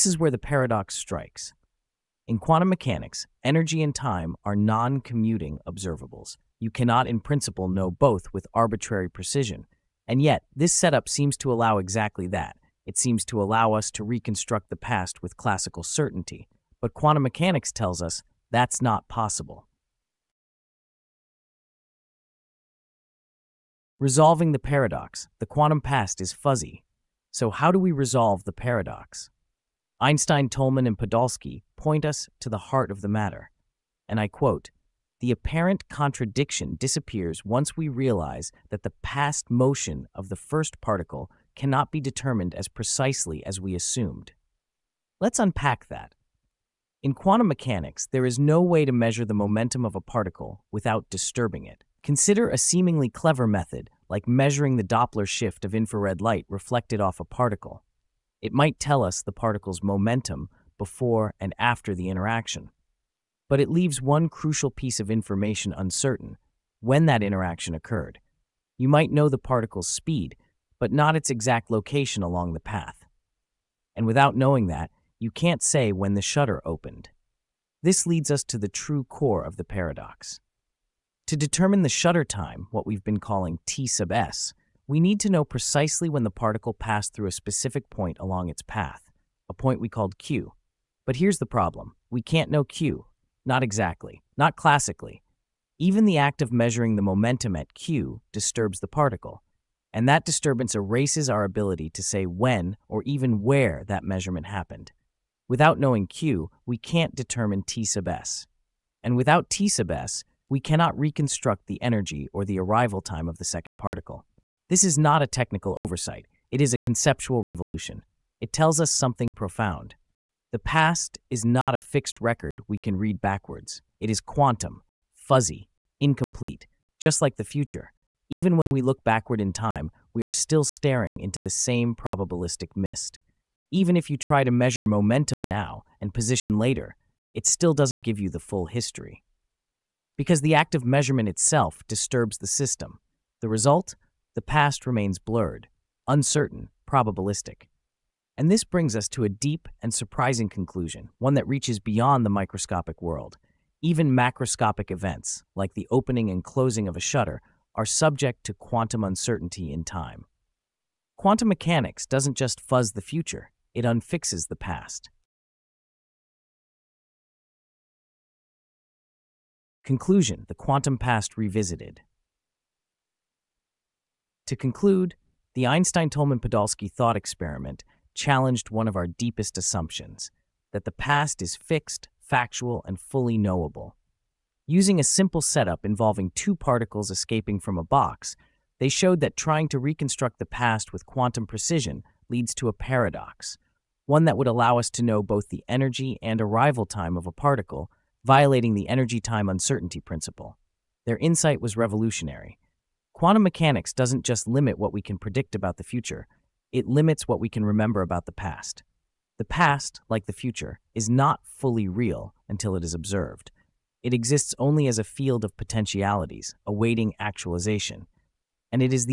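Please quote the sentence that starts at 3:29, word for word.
The past, like the future, is not fully real until it is observed.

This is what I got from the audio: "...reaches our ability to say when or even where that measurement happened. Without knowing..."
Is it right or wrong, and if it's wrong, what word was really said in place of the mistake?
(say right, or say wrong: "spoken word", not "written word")
wrong: "erases", not "reaches".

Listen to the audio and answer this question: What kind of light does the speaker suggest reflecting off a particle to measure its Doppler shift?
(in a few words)
Infrared light.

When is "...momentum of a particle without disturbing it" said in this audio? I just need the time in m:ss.
0:49.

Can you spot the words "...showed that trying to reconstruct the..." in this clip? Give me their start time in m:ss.
3:08.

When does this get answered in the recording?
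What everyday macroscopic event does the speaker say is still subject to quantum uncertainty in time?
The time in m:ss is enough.
2:35.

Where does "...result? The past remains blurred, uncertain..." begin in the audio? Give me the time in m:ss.
2:23.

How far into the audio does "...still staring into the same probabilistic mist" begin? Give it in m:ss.
2:10.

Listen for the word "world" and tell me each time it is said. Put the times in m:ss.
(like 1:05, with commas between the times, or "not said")
2:33.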